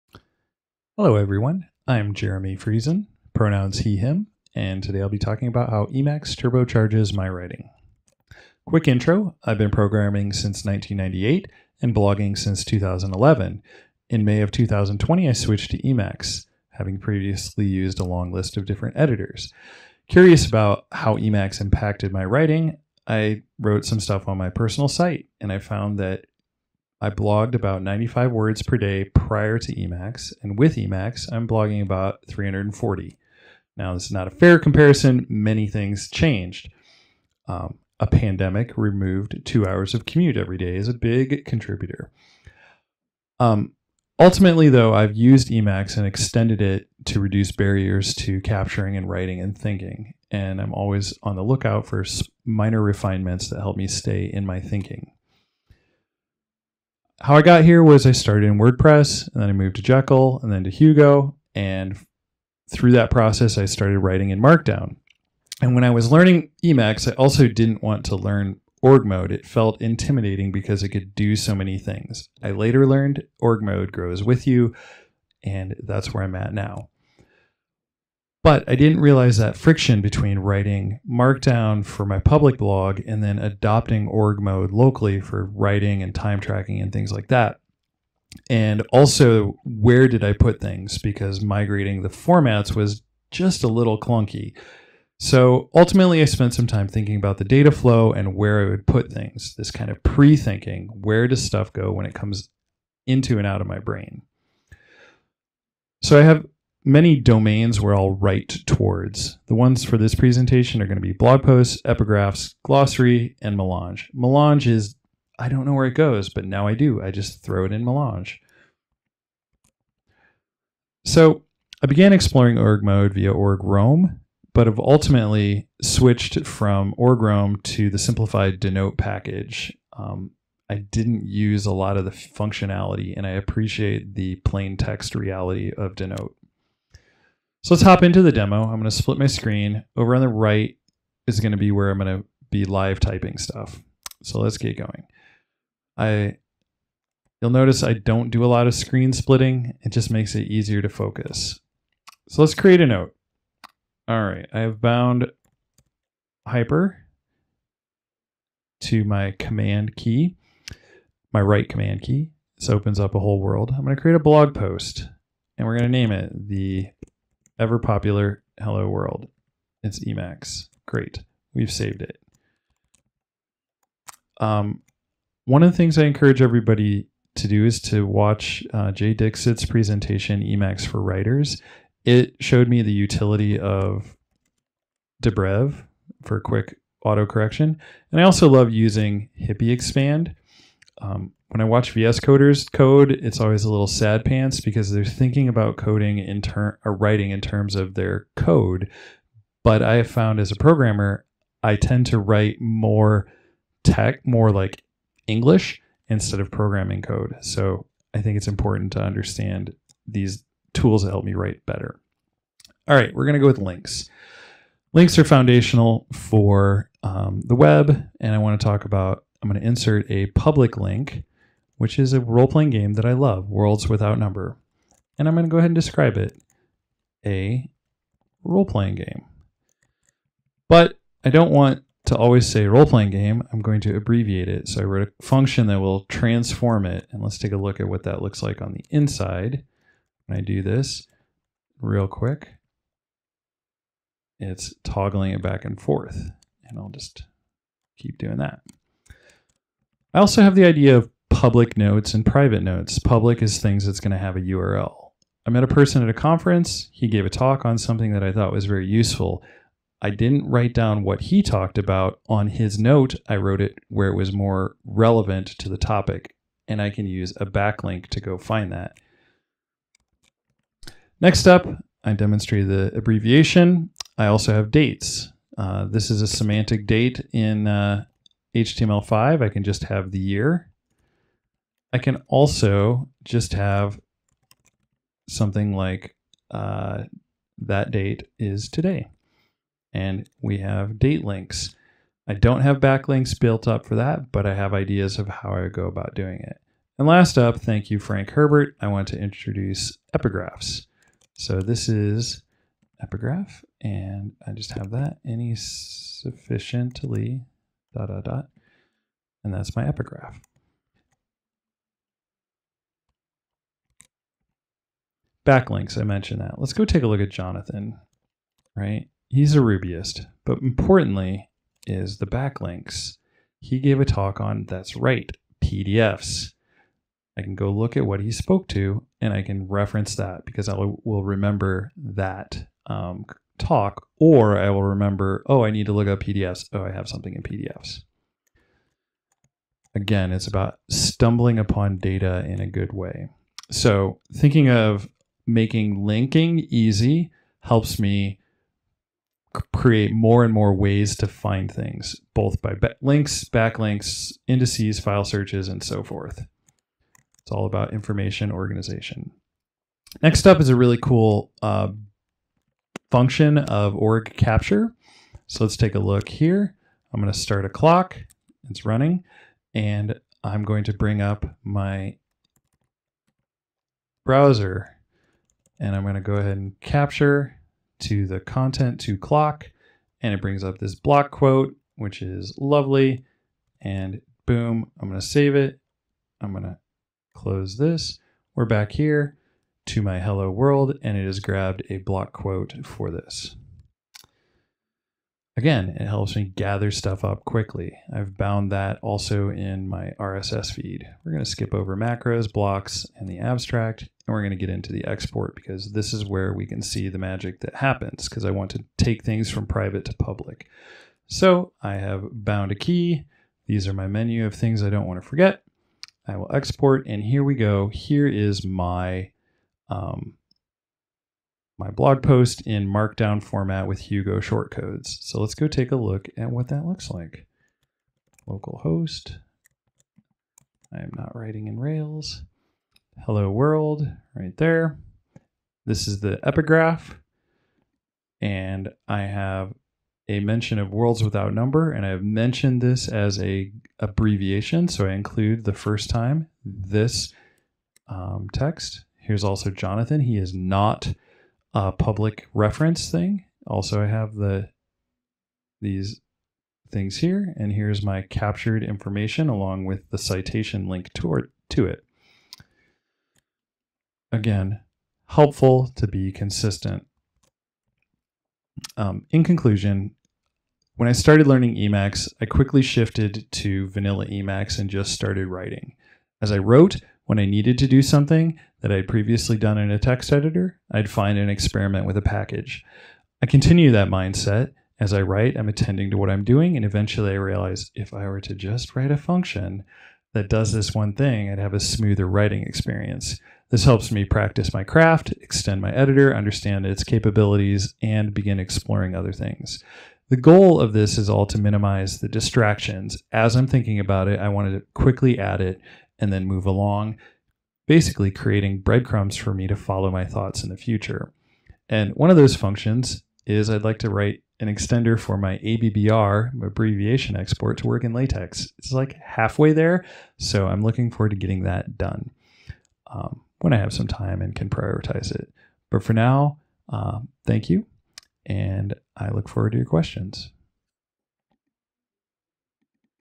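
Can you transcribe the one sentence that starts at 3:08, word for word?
And I also love using Hippie Expand.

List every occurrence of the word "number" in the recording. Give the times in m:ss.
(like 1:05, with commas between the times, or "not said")
3:44, 7:21.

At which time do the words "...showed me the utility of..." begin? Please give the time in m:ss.
3:02.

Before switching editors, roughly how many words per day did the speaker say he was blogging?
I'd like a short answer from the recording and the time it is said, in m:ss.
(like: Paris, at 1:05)
95, at 0:27.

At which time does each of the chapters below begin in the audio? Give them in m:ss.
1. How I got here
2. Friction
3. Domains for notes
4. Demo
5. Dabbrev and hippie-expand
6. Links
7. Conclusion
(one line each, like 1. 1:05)
1. 0:57
2. 1:18
3. 1:45
4. 2:15
5. 2:55
6. 3:32
7. 7:49.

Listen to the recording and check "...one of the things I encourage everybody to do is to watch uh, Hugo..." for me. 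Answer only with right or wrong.
wrong.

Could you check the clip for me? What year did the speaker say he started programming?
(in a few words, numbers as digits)
1998.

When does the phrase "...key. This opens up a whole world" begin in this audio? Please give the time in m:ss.
2:42.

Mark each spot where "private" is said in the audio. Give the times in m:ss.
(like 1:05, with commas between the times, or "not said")
4:12, 6:49.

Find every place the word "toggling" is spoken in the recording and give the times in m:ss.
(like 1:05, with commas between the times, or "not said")
4:04.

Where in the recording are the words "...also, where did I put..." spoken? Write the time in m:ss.
1:28.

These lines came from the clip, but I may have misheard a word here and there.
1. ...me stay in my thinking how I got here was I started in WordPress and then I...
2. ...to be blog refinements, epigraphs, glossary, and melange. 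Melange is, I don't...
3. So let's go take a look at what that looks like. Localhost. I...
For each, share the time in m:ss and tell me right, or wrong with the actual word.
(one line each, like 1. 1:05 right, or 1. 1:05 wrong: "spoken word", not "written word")
1. 0:53 right
2. 1:50 wrong: "posts", not "refinements"
3. 7:05 right.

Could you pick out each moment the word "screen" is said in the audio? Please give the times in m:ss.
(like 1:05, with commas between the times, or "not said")
2:19, 2:28.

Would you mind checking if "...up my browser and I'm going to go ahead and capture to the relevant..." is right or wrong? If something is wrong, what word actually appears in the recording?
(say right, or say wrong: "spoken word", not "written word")
wrong: "content", not "relevant".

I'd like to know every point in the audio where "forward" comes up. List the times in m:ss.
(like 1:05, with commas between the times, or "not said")
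8:41, 8:49.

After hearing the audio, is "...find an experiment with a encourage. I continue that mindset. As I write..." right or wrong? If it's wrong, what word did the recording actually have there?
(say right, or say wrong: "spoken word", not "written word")
wrong: "package", not "encourage".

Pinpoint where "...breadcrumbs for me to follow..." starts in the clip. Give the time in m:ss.
8:28.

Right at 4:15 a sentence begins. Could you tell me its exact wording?
I met a person at a conference.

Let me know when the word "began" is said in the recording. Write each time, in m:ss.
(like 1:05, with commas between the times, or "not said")
2:01.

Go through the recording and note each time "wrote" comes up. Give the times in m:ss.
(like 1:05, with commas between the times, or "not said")
0:23, 3:54, 4:23, 7:56.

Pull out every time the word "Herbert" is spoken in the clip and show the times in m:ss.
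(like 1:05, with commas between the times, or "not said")
4:58.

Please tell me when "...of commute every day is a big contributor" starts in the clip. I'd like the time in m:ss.
0:39.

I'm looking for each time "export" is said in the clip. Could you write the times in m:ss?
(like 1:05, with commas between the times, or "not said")
6:45, 6:56, 8:37.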